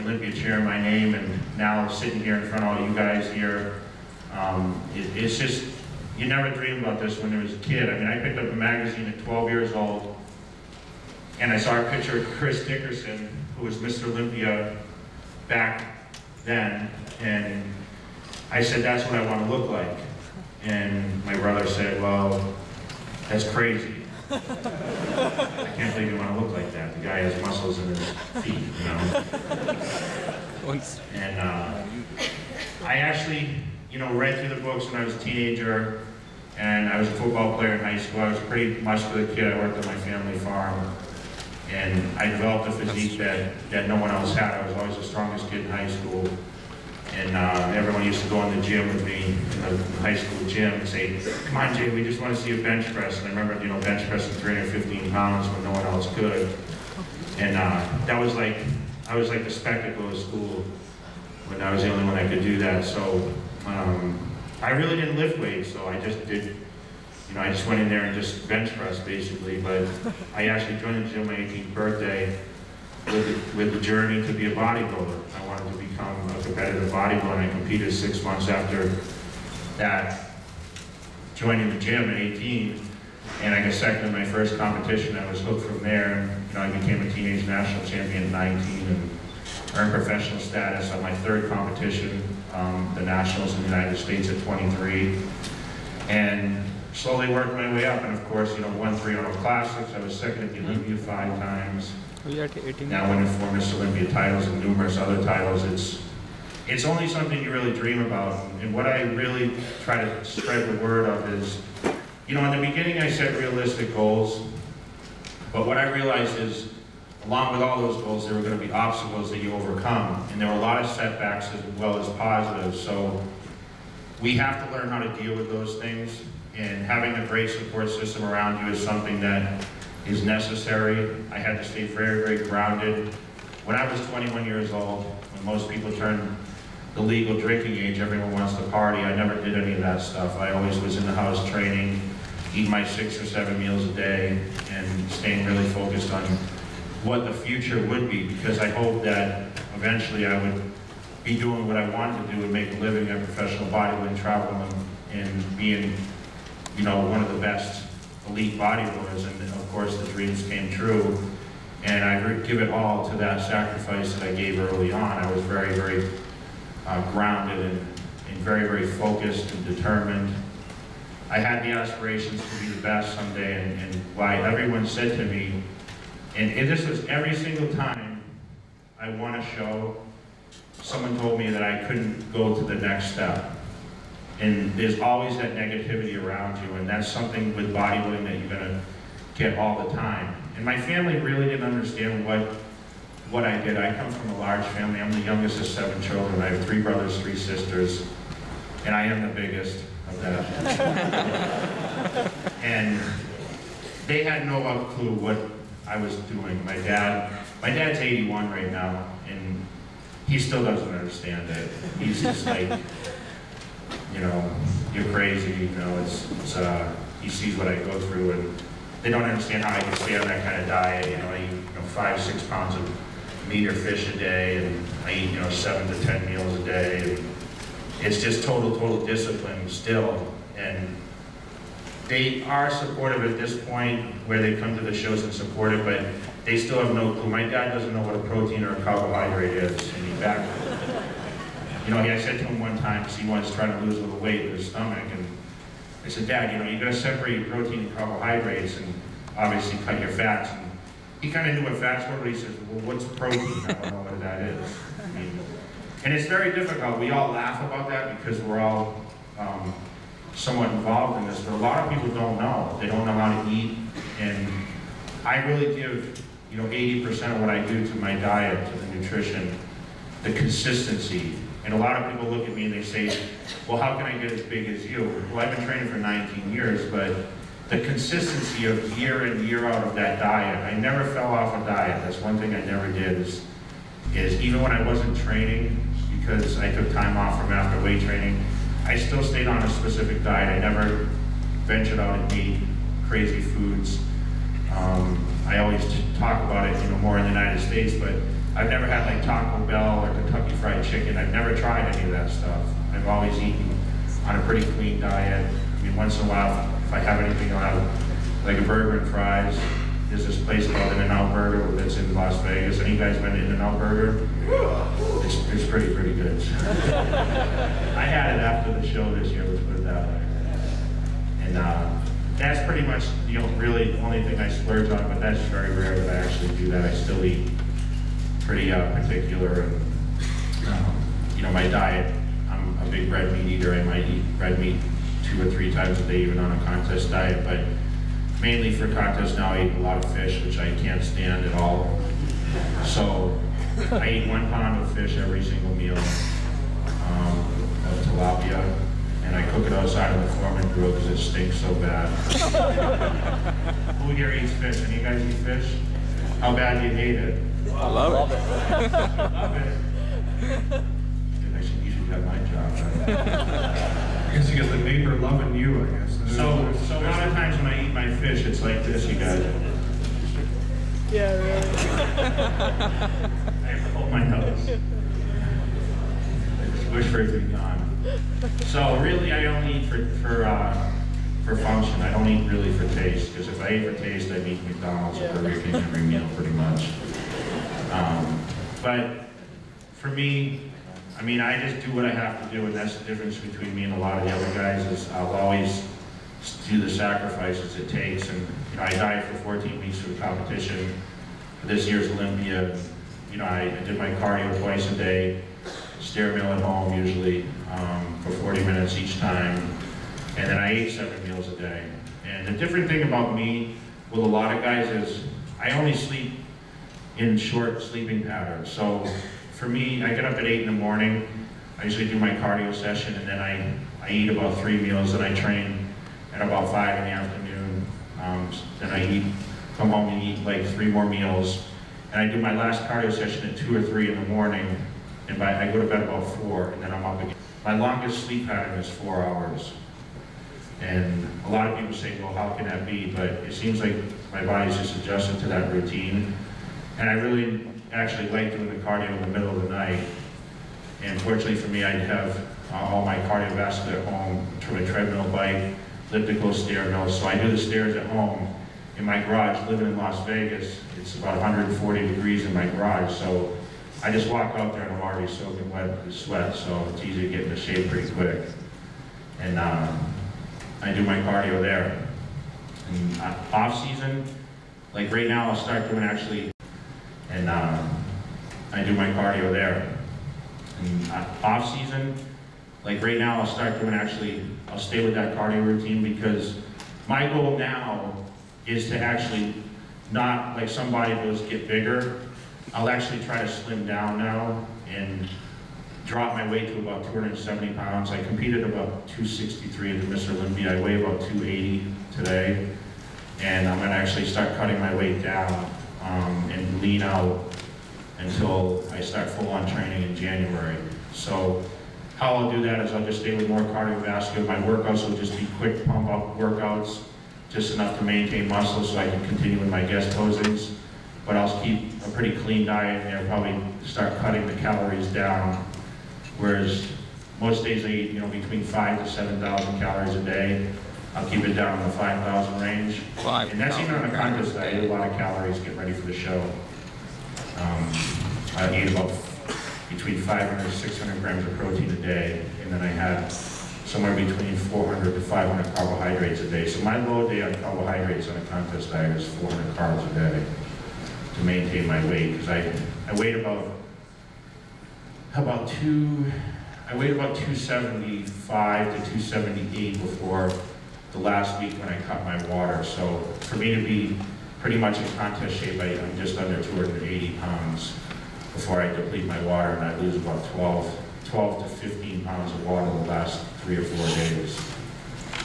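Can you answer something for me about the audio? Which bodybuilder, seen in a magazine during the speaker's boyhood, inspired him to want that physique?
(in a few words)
Chris Dickerson.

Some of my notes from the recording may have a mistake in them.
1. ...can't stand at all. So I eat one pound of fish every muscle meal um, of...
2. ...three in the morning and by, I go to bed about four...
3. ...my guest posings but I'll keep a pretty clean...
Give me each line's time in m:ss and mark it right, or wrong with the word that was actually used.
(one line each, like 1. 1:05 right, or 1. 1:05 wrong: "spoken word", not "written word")
1. 5:40 wrong: "single", not "muscle"
2. 7:13 right
3. 8:39 right.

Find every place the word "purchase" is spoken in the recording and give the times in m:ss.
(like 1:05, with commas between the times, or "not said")
not said.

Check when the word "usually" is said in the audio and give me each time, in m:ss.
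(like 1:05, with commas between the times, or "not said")
6:47, 7:01.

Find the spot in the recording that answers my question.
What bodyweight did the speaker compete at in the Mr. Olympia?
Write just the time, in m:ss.
8:19.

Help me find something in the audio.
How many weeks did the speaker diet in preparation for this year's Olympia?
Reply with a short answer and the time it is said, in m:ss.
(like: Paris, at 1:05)
14, at 6:39.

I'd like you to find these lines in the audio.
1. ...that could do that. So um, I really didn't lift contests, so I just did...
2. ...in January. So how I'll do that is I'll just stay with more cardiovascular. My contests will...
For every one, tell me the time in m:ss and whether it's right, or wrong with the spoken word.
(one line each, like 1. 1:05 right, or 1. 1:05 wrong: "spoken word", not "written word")
1. 1:02 wrong: "weights", not "contests"
2. 8:30 wrong: "workouts", not "contests".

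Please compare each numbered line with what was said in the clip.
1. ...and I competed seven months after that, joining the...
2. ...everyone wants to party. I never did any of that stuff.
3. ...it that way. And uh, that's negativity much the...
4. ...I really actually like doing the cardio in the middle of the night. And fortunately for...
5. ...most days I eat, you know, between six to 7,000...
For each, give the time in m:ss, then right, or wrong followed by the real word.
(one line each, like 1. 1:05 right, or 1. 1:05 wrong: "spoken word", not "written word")
1. 1:17 wrong: "six", not "seven"
2. 2:17 right
3. 5:19 wrong: "pretty", not "negativity"
4. 7:27 right
5. 8:47 wrong: "five", not "six".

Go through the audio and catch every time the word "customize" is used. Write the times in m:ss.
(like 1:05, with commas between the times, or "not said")
not said.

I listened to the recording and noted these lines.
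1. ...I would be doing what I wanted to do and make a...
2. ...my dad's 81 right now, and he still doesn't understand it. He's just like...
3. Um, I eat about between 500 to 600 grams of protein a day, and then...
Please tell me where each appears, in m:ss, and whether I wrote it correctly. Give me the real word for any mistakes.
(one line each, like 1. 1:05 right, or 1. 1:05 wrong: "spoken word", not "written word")
1. 2:30 right
2. 3:27 right
3. 8:57 right.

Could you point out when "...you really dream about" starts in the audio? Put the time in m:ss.
1:47.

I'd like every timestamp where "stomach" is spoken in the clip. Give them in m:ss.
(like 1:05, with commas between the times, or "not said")
4:04.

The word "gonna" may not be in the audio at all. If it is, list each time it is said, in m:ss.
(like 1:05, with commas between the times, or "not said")
3:08, 8:23.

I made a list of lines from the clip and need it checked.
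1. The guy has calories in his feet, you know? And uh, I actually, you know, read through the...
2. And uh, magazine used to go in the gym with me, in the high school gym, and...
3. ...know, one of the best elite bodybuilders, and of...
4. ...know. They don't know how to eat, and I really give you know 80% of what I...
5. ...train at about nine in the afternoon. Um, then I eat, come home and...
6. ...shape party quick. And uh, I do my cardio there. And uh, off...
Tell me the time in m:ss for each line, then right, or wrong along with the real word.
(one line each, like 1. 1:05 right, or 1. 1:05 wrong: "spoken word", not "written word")
1. 0:26 wrong: "muscles", not "calories"
2. 0:47 wrong: "everyone", not "magazine"
3. 2:36 right
4. 4:22 right
5. 7:05 wrong: "five", not "nine"
6. 7:47 wrong: "pretty", not "party".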